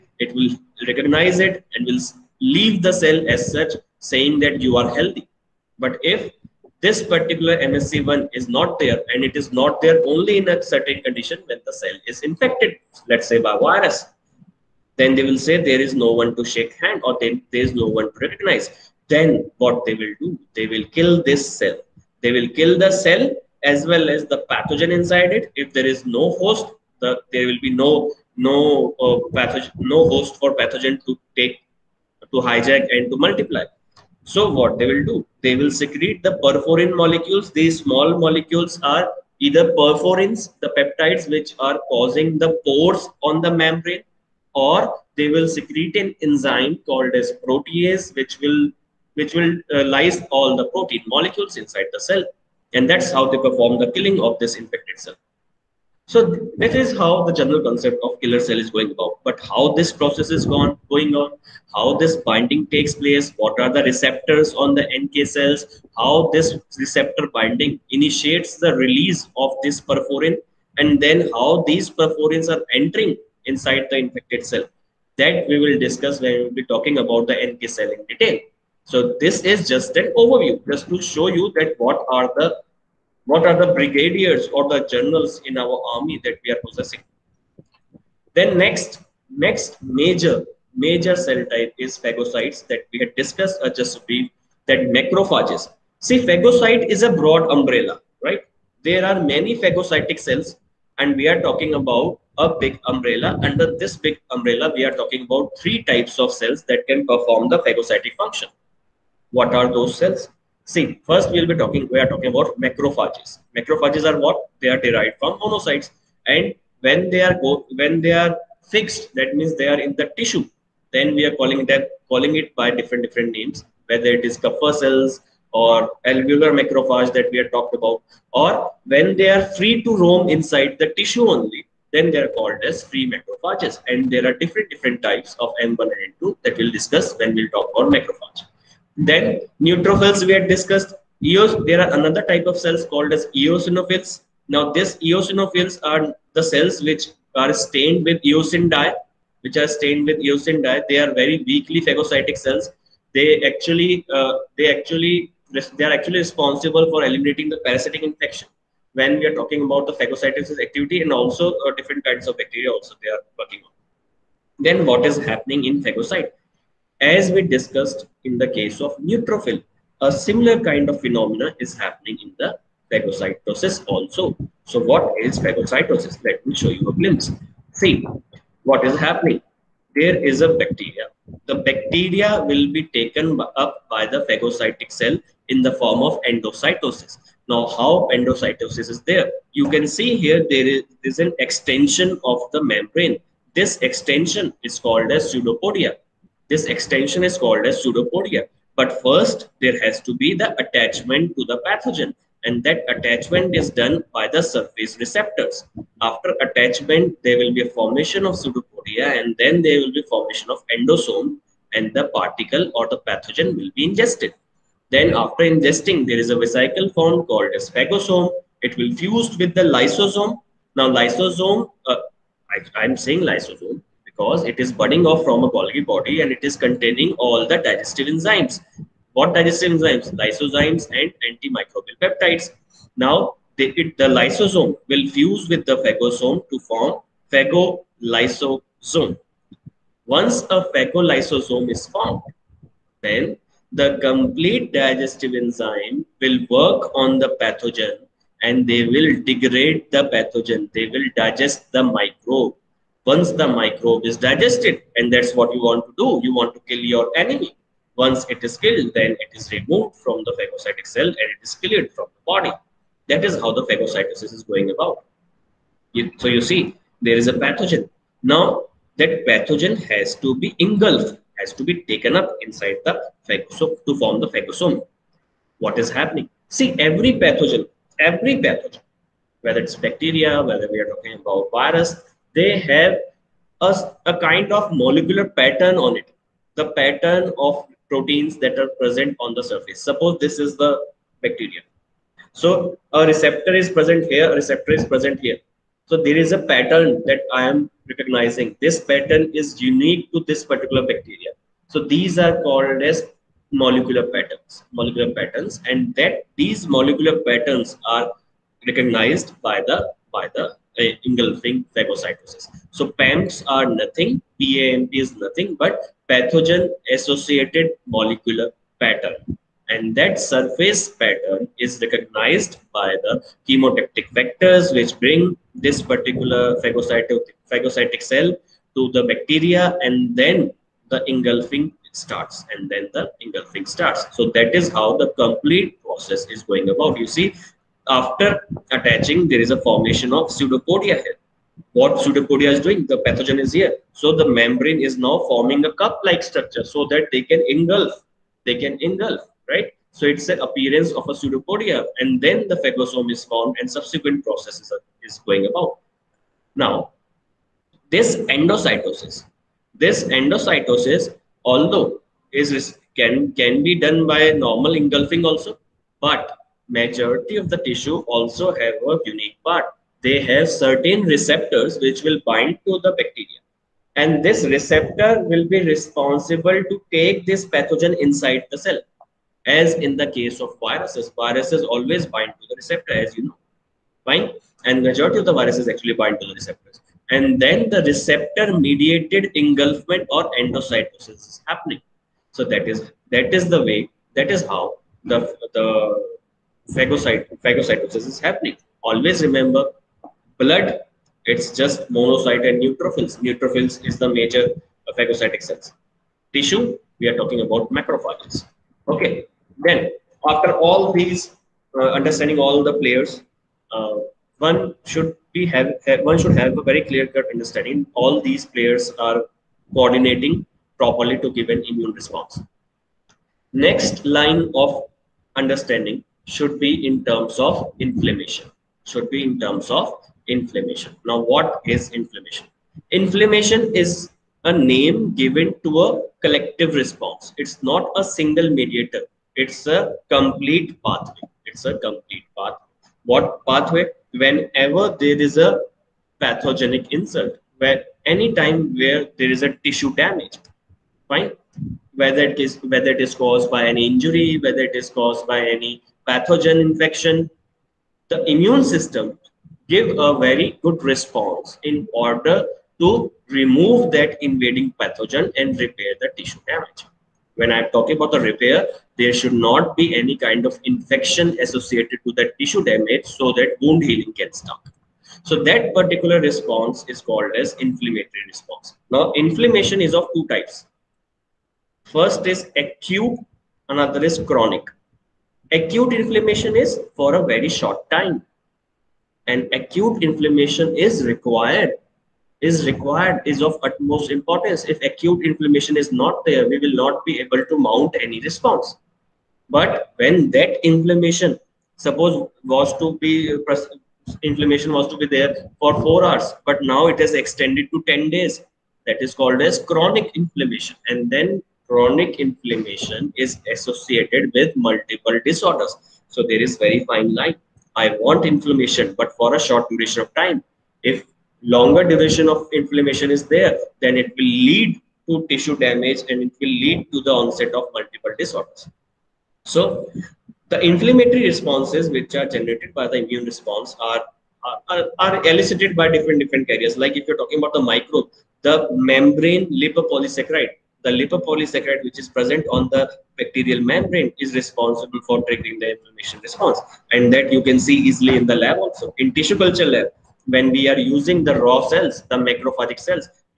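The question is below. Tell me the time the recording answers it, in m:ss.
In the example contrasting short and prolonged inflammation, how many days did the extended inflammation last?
8:27.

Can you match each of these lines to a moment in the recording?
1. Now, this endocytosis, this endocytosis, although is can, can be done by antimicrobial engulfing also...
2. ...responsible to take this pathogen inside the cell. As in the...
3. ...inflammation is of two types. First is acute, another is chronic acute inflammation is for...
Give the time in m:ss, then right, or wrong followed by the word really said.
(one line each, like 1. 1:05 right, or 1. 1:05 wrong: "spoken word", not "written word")
1. 5:56 wrong: "normal", not "antimicrobial"
2. 6:15 right
3. 7:59 right.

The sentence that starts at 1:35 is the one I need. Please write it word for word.
See, phagocyte is a broad umbrella, right?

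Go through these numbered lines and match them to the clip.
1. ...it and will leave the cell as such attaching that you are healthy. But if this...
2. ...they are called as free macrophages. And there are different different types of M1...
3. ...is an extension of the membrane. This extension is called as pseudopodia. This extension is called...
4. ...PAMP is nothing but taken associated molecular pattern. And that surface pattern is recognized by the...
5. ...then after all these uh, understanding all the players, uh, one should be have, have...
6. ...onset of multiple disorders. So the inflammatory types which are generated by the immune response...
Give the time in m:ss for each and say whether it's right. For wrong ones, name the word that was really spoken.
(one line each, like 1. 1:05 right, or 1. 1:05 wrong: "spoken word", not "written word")
1. 0:01 wrong: "saying", not "attaching"
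2. 2:12 right
3. 3:11 right
4. 5:14 wrong: "pathogen", not "taken"
5. 6:49 right
6. 8:47 wrong: "responses", not "types".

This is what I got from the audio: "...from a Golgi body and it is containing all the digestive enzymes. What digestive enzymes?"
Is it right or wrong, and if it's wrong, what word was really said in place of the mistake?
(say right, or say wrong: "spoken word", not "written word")
right.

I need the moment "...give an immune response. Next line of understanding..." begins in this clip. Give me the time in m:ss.
7:01.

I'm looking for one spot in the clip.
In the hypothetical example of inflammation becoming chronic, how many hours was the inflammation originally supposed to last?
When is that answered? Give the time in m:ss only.
8:25.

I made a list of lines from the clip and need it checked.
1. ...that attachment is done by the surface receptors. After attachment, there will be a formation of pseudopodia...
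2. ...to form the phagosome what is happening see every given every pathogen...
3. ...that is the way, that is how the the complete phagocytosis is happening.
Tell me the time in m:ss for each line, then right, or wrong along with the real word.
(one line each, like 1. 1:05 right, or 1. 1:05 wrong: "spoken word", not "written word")
1. 3:22 right
2. 4:33 wrong: "pathogen", not "given"
3. 6:33 wrong: "phagocyte", not "complete".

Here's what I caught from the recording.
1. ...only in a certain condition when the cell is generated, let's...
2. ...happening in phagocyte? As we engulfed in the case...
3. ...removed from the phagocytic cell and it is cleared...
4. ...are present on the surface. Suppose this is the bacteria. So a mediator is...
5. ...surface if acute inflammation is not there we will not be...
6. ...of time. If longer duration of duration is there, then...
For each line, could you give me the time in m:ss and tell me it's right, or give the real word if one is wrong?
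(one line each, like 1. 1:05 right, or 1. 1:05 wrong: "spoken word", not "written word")
1. 0:10 wrong: "infected", not "generated"
2. 2:45 wrong: "discussed", not "engulfed"
3. 4:19 right
4. 4:48 wrong: "receptor", not "mediator"
5. 8:14 wrong: "importance", not "surface"
6. 8:40 wrong: "inflammation", not "duration".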